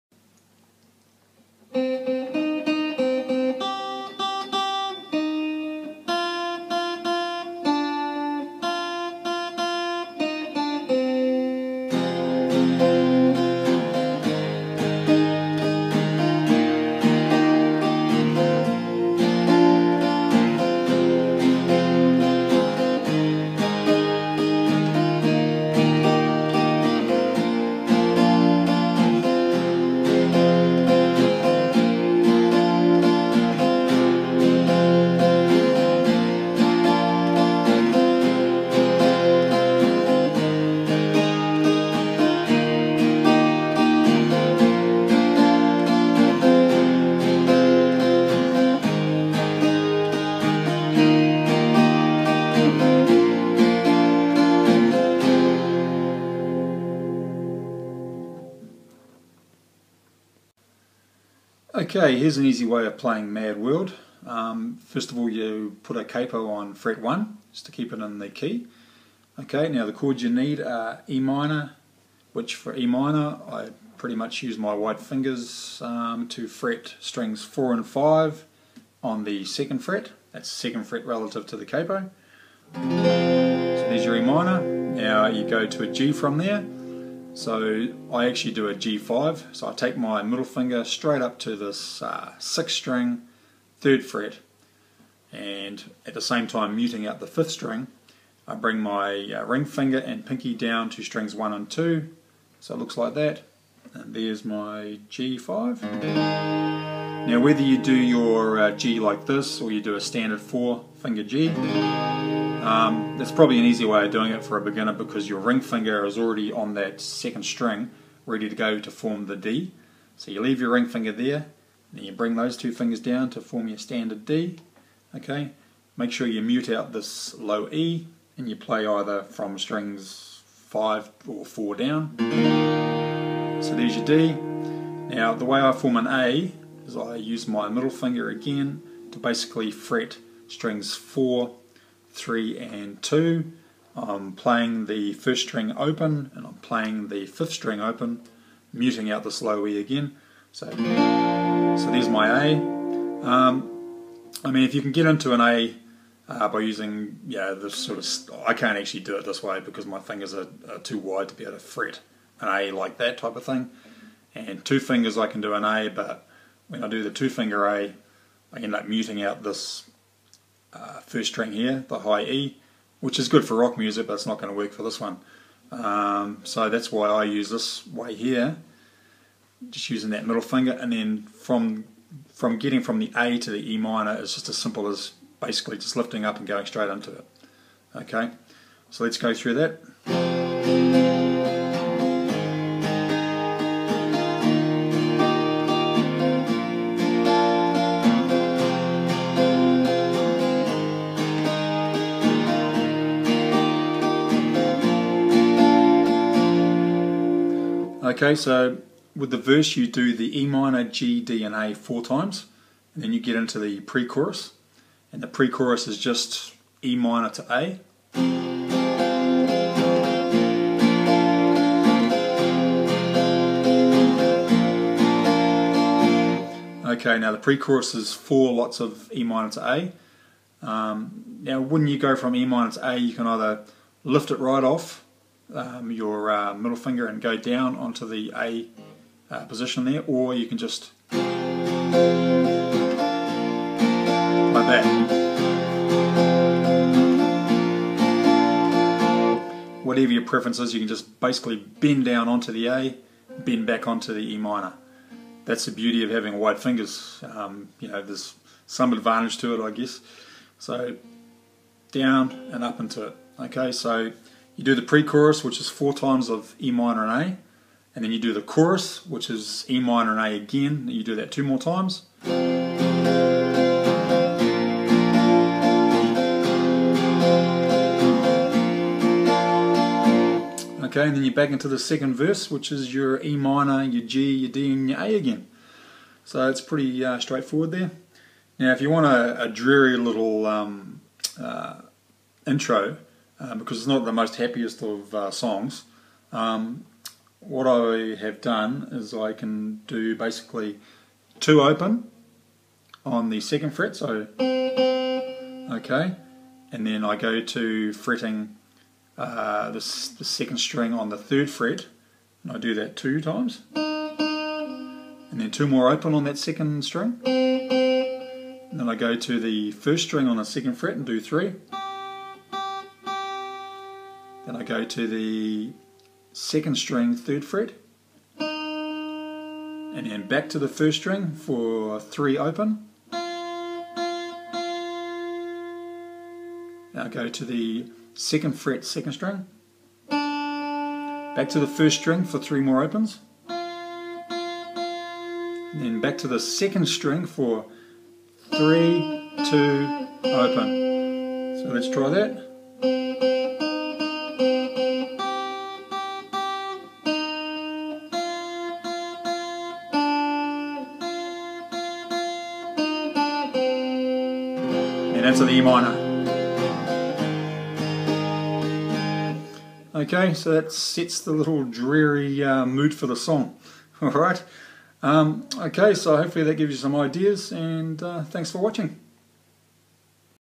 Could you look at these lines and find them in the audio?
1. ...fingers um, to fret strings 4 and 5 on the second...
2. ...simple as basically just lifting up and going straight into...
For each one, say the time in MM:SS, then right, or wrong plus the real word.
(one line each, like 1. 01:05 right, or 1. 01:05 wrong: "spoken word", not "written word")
1. 01:14 right
2. 03:04 right.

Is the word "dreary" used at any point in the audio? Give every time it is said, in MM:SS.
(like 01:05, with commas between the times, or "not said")
04:49, 06:11.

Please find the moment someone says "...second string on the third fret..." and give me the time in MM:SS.
05:10.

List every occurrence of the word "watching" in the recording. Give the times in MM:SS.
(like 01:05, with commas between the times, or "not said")
06:18.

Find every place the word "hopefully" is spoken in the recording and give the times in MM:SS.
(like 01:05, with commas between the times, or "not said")
06:16.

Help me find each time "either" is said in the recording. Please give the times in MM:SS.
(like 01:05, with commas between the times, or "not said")
02:08, 03:53.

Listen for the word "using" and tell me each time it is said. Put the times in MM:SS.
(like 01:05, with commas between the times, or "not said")
02:36, 02:59.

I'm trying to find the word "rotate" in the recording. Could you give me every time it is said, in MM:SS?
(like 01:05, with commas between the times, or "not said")
not said.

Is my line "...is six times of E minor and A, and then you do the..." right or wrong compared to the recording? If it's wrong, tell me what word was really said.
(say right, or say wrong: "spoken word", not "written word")
wrong: "four", not "six".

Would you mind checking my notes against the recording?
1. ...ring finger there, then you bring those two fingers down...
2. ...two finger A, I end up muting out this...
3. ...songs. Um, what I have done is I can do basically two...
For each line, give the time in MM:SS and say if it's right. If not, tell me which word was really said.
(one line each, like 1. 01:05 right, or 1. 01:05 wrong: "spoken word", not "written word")
1. 02:00 right
2. 02:47 right
3. 04:55 right.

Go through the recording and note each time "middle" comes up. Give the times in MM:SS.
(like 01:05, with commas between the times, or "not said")
01:30, 02:17, 03:00, 03:56.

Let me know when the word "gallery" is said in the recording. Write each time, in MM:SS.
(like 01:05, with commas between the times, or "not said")
not said.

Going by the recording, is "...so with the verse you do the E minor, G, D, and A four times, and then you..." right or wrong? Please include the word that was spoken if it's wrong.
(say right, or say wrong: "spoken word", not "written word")
right.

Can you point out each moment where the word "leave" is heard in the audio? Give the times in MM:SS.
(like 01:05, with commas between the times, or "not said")
02:00.